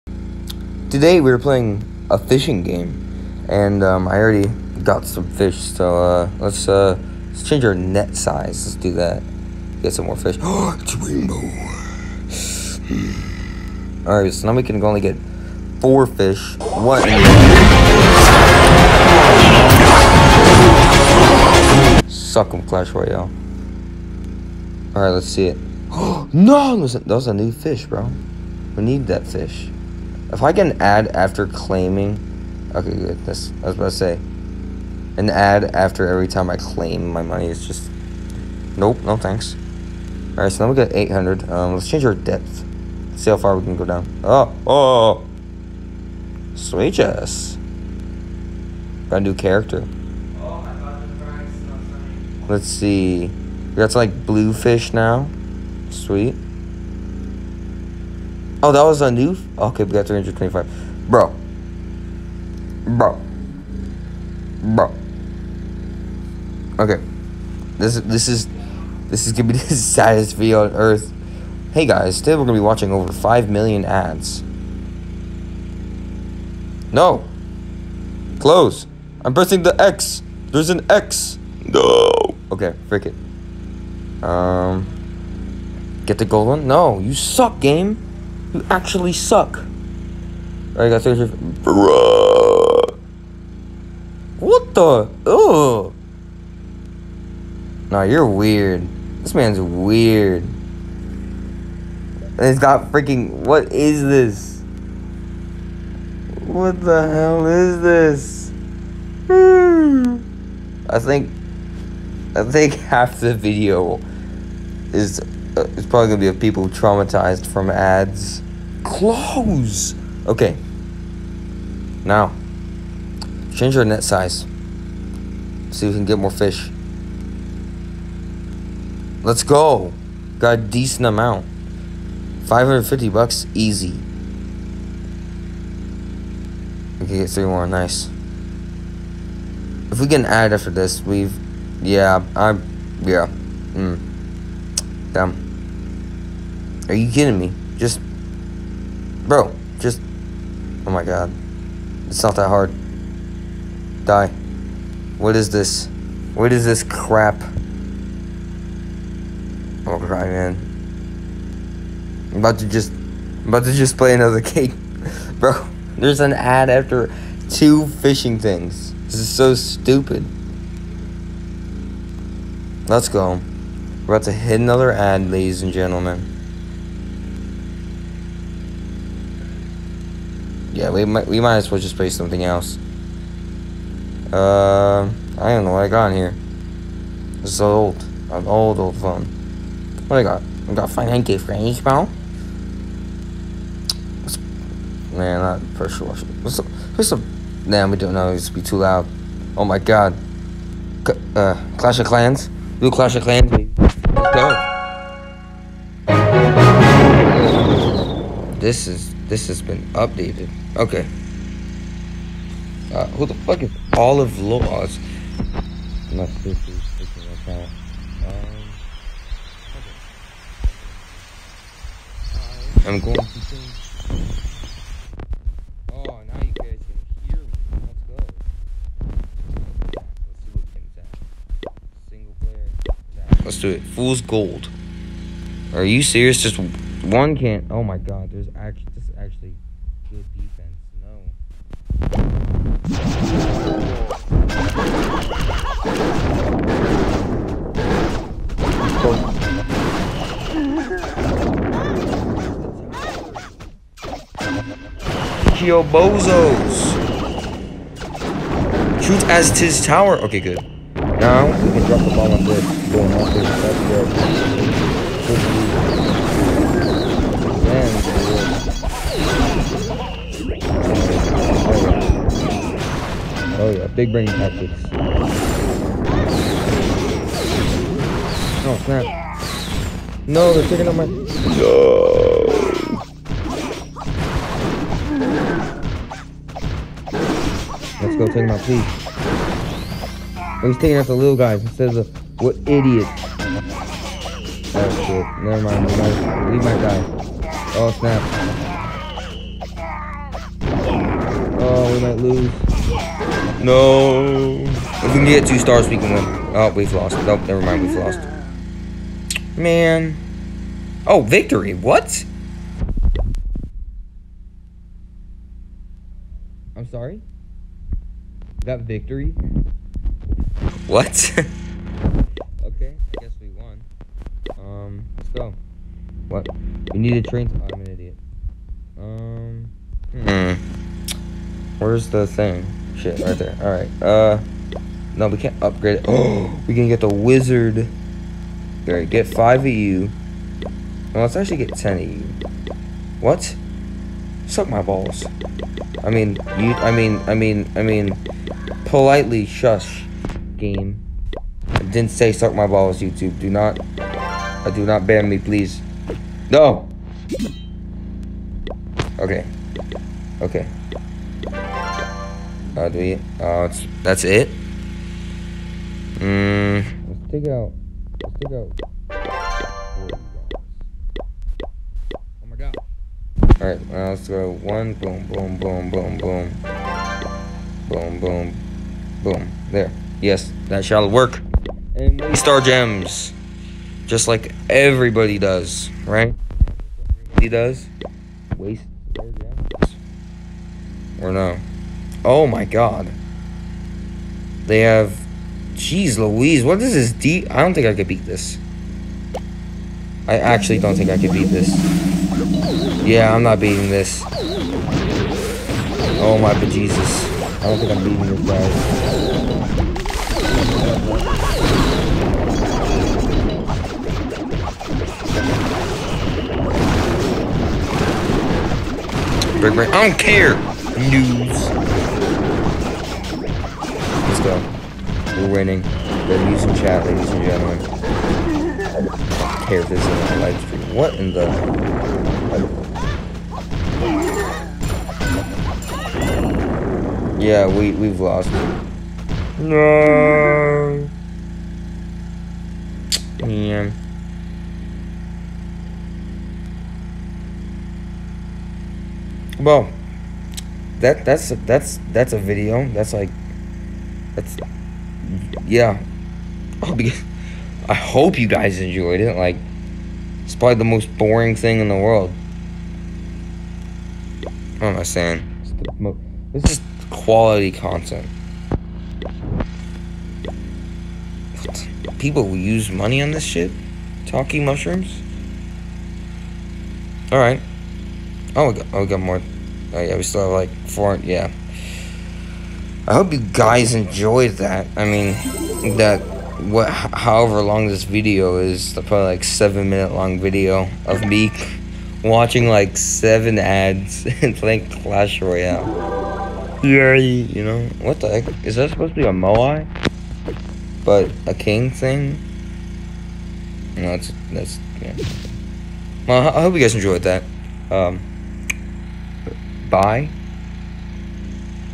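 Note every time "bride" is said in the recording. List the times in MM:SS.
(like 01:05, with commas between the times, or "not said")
not said.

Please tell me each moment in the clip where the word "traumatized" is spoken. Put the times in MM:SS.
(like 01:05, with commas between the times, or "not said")
01:56.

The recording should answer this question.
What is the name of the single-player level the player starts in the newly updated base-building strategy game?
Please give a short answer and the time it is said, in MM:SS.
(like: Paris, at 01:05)
Fool's Gold, at 03:53.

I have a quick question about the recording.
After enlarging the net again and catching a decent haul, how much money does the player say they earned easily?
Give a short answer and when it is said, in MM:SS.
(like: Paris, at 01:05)
550, at 02:12.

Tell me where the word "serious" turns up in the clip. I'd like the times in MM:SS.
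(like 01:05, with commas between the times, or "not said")
01:31, 03:56.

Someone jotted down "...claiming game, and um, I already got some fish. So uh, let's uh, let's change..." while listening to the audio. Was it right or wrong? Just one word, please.
wrong.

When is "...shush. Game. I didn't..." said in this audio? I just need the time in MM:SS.
05:49.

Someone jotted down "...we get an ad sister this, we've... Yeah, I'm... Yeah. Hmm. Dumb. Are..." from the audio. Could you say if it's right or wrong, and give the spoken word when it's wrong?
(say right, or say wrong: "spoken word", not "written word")
wrong: "after", not "sister".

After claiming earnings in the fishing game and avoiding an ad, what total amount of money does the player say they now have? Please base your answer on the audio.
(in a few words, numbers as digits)
800.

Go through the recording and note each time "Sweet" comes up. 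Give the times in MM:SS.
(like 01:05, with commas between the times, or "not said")
00:46, 00:55.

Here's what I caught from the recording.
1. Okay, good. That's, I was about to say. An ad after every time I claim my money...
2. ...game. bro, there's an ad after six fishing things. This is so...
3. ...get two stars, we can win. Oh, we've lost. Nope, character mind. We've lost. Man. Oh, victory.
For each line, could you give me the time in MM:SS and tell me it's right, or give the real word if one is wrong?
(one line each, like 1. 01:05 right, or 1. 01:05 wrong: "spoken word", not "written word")
1. 00:32 right
2. 02:44 wrong: "two", not "six"
3. 05:05 wrong: "never", not "character".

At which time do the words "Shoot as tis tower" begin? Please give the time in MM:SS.
04:19.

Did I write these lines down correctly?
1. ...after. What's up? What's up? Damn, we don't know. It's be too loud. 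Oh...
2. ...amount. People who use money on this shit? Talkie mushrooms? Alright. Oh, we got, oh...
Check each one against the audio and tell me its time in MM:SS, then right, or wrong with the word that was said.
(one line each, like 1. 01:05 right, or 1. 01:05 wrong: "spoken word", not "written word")
1. 03:16 wrong: "washer", not "after"
2. 07:47 wrong: "content", not "amount".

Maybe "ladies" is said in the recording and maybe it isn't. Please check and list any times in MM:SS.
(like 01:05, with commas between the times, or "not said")
02:55, 07:07.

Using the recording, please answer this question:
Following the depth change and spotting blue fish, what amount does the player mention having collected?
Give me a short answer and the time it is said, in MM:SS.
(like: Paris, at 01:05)
325, at 01:00.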